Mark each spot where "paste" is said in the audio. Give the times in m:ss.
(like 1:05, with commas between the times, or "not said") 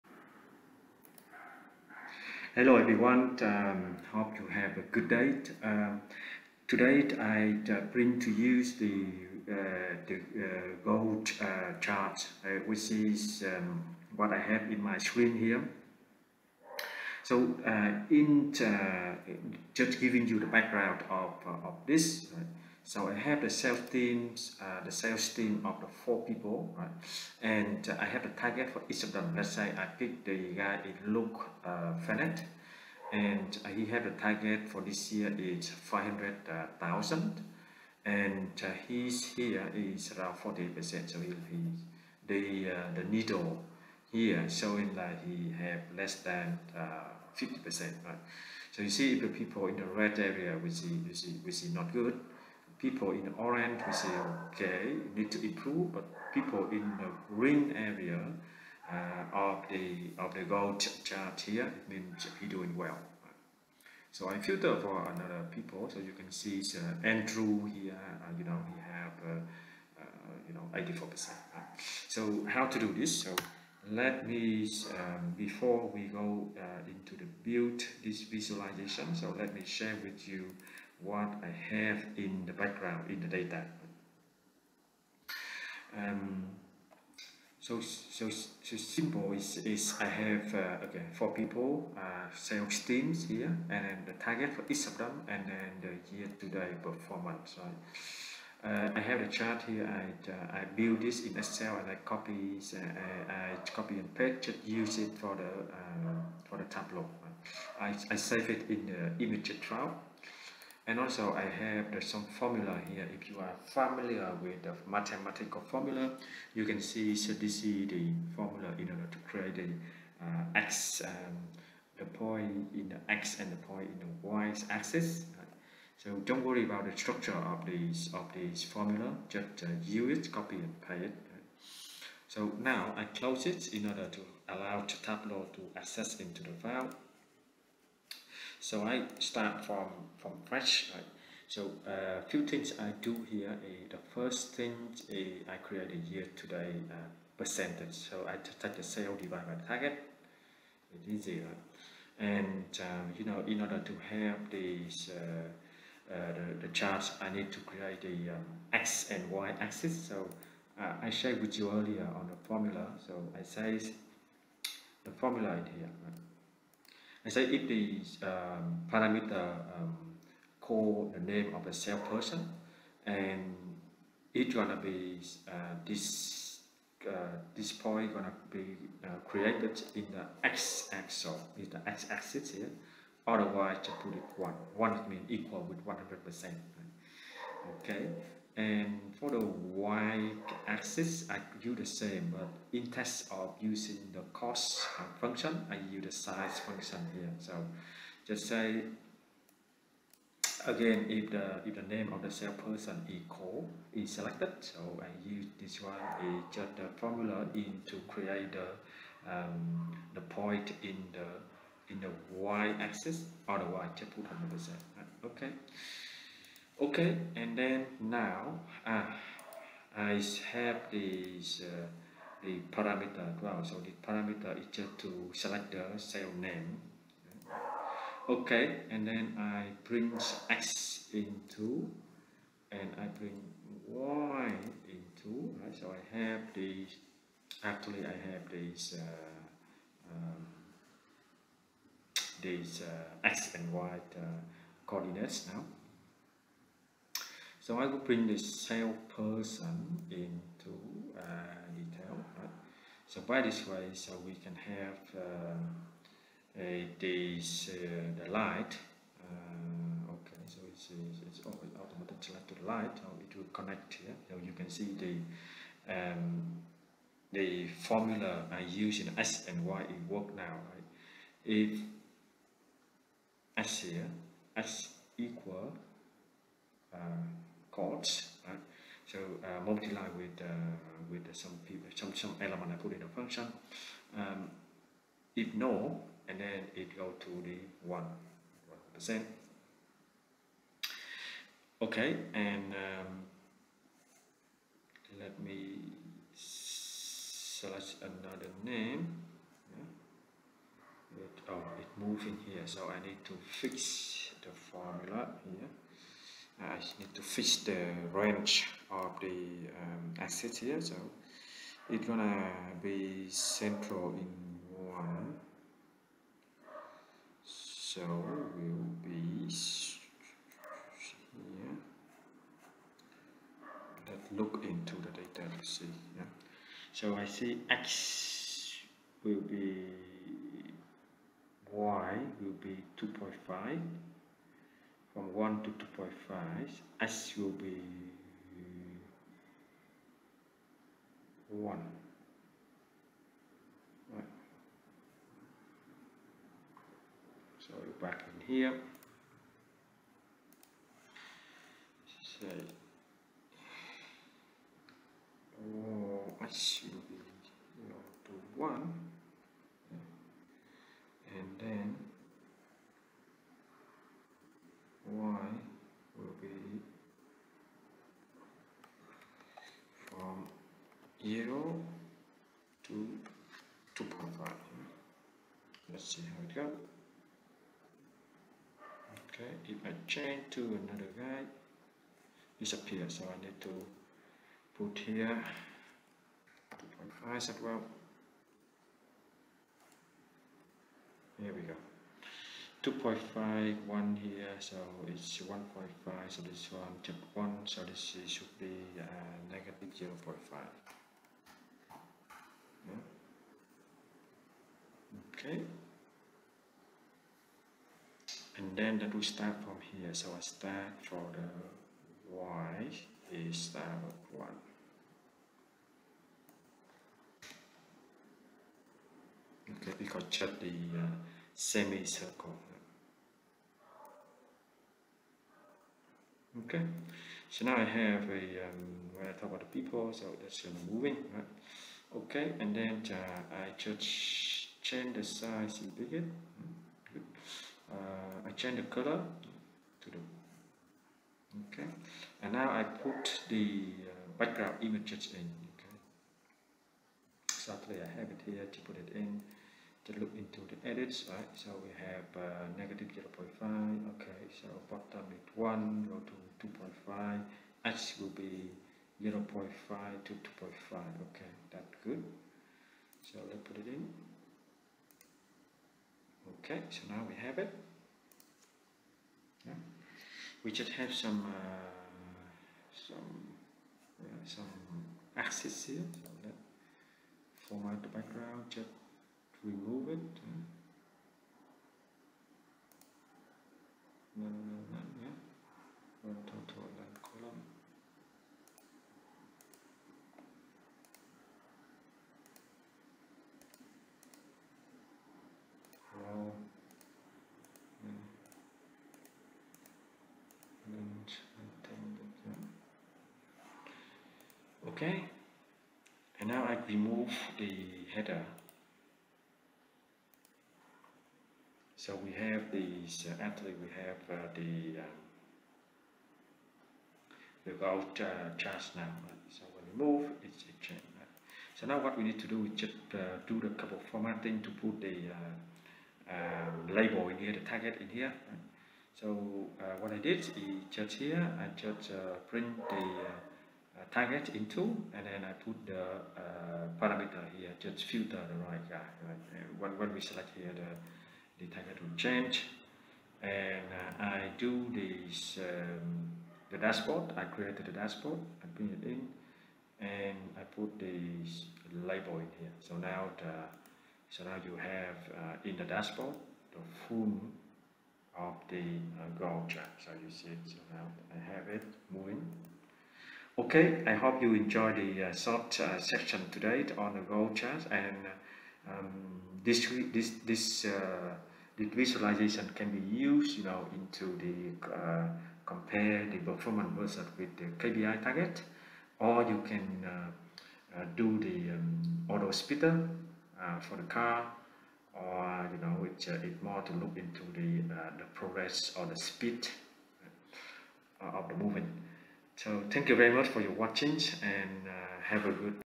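1:44, 2:10.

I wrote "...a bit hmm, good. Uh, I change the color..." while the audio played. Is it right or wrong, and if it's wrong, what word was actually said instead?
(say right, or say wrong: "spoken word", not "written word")
right.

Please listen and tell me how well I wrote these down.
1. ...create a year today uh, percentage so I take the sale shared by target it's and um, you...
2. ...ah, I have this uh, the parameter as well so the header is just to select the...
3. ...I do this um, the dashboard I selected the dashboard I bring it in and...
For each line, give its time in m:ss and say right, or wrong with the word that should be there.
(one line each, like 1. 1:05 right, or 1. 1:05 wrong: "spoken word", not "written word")
1. 2:25 wrong: "divided", not "shared"
2. 3:38 wrong: "parameter", not "header"
3. 9:04 wrong: "created", not "selected".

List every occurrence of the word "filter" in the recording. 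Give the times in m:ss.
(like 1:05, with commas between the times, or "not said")
1:04, 8:58.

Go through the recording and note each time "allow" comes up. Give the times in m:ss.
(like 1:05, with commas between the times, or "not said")
2:14.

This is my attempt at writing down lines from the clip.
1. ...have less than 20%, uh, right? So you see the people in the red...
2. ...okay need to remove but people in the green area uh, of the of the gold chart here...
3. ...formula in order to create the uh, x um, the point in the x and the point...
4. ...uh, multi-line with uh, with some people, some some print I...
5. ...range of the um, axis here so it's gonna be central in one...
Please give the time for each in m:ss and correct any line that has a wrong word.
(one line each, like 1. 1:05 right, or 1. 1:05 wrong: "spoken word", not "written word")
1. 0:45 wrong: "50", not "20"
2. 0:54 wrong: "improve", not "remove"
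3. 1:58 right
4. 4:39 wrong: "element", not "print"
5. 5:08 right.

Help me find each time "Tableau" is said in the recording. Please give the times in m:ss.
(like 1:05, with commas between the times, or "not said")
1:46, 2:15.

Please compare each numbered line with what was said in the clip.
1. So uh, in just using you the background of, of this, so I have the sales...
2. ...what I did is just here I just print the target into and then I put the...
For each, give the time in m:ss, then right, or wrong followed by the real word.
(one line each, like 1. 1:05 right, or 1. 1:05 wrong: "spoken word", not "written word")
1. 0:17 wrong: "giving", not "using"
2. 8:49 right.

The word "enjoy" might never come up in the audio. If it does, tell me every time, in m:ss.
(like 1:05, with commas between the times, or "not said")
9:24.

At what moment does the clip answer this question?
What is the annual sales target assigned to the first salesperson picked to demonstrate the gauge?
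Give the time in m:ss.
0:35.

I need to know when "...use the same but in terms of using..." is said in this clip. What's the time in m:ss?
3:11.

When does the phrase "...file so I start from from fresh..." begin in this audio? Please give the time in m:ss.
2:16.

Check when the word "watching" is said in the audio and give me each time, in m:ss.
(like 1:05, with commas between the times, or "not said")
9:53.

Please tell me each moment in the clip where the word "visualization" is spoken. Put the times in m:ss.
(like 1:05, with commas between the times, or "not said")
1:18, 9:31.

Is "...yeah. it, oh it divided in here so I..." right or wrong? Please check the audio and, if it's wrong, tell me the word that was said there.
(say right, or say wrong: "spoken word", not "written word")
wrong: "moved", not "divided".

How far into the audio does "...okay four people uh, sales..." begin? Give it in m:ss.
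1:30.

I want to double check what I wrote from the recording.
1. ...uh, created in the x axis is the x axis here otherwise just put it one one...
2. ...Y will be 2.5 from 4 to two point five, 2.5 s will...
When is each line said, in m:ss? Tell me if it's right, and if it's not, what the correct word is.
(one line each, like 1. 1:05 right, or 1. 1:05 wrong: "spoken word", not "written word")
1. 2:59 right
2. 5:31 wrong: "1", not "4".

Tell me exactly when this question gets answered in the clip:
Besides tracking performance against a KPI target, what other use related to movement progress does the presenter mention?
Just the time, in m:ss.
9:49.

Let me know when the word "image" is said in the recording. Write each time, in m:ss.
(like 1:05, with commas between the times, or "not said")
1:49, 7:24.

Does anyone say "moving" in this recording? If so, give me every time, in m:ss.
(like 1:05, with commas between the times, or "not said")
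7:10, 9:22.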